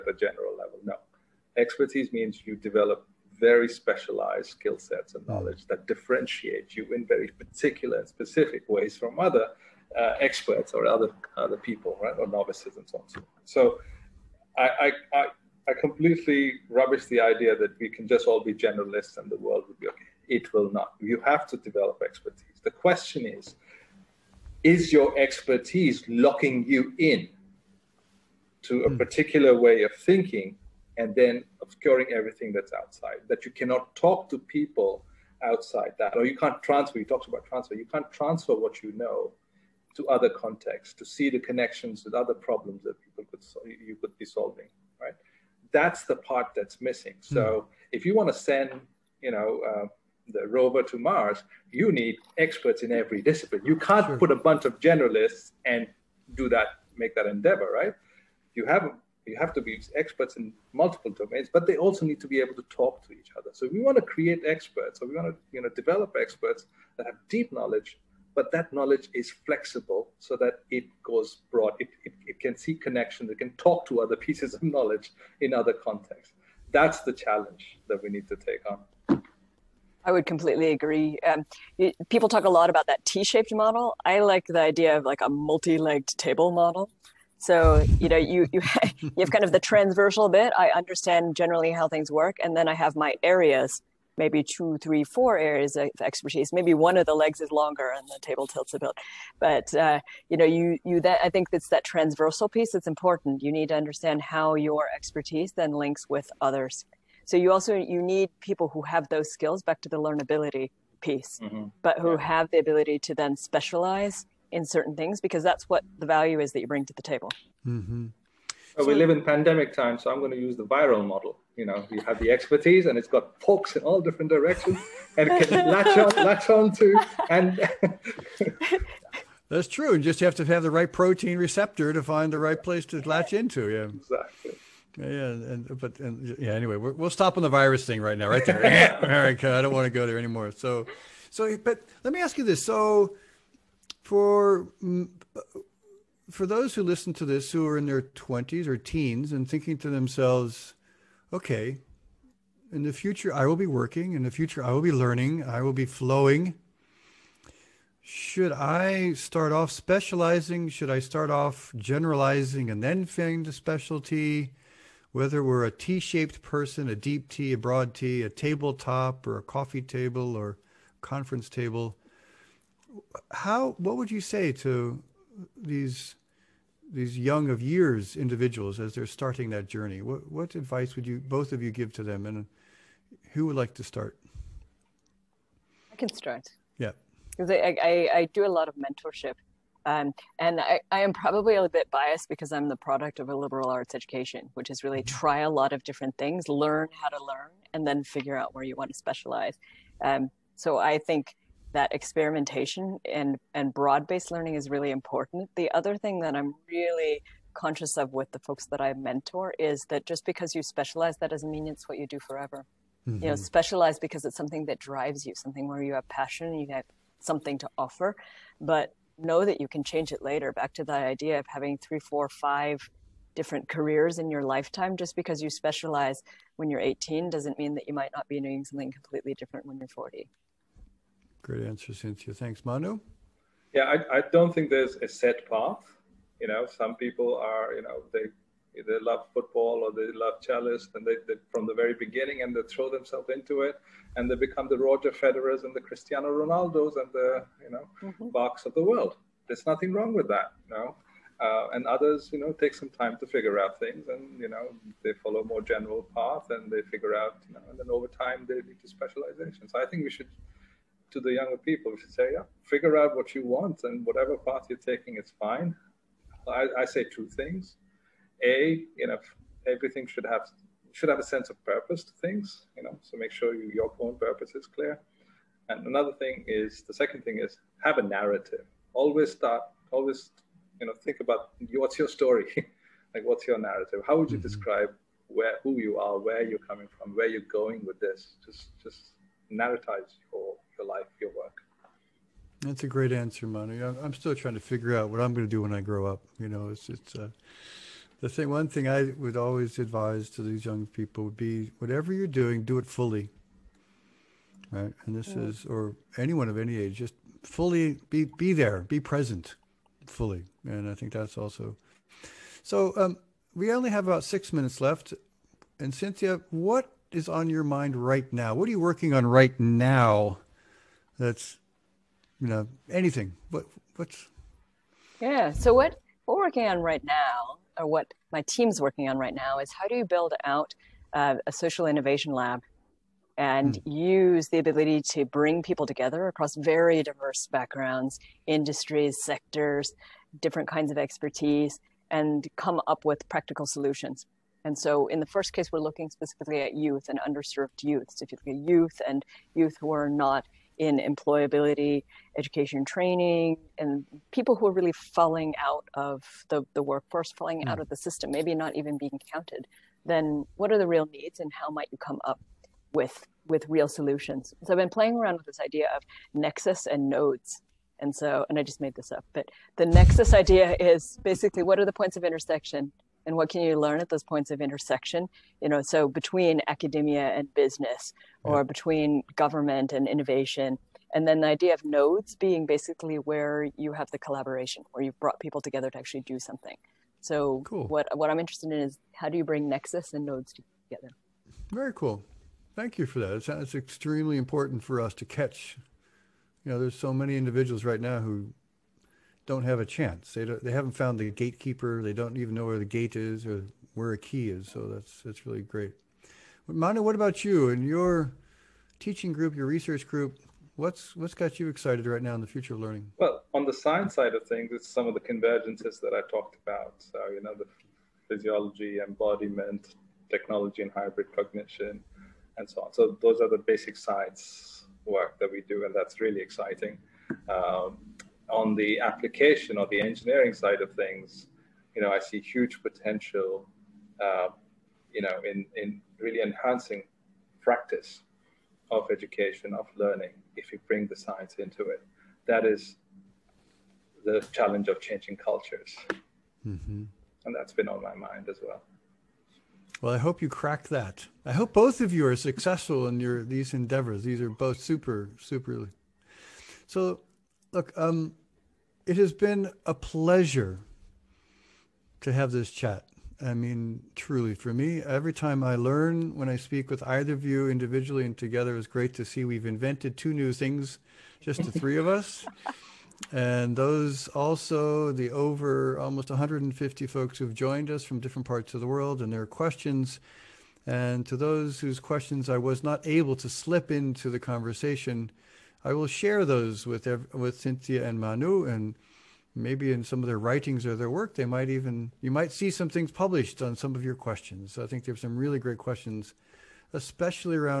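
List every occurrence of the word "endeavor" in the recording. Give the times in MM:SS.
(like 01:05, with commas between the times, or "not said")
00:57, 07:33.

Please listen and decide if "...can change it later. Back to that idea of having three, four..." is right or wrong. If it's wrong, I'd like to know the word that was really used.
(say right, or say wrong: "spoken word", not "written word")
right.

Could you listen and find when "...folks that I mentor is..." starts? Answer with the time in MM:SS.
03:28.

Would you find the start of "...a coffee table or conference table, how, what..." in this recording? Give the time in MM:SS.
02:49.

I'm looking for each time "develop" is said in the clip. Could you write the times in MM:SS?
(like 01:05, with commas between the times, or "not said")
00:02, 00:21, 01:05.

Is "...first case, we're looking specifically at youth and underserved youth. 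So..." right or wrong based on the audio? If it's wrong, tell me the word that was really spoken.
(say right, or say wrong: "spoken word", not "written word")
right.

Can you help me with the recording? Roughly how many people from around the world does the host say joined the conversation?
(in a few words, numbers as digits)
150.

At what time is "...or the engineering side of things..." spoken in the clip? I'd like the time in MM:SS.
07:09.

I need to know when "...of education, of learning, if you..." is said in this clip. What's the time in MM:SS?
07:18.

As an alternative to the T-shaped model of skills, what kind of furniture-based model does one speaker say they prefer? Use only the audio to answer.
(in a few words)
Multi-legged table.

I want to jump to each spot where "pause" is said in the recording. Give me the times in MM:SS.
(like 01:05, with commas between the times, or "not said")
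not said.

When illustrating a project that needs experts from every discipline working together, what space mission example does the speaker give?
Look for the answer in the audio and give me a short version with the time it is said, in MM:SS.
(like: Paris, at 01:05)
Rover to Mars, at 00:50.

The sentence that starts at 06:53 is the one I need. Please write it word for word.
Well, on the science side of things, it's some of the convergences that I talked about.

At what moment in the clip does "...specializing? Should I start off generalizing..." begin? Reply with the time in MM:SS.
02:39.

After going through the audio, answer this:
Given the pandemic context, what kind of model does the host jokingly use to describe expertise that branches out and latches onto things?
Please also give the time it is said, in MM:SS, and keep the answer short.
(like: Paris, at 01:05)
Viral model, at 02:00.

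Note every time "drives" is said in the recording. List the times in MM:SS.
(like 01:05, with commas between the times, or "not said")
03:34.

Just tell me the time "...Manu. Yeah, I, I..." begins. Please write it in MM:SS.
03:52.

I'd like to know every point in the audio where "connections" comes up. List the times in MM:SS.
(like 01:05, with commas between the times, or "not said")
00:41, 01:12.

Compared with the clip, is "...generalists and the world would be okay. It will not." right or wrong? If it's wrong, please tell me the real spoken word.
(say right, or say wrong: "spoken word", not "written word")
right.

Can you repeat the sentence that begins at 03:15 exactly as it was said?
try a lot of different things, learn how to learn, and then figure out where you want to specialize.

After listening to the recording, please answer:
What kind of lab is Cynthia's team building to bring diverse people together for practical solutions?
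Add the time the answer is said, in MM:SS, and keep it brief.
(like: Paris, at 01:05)
Social innovation lab, at 05:31.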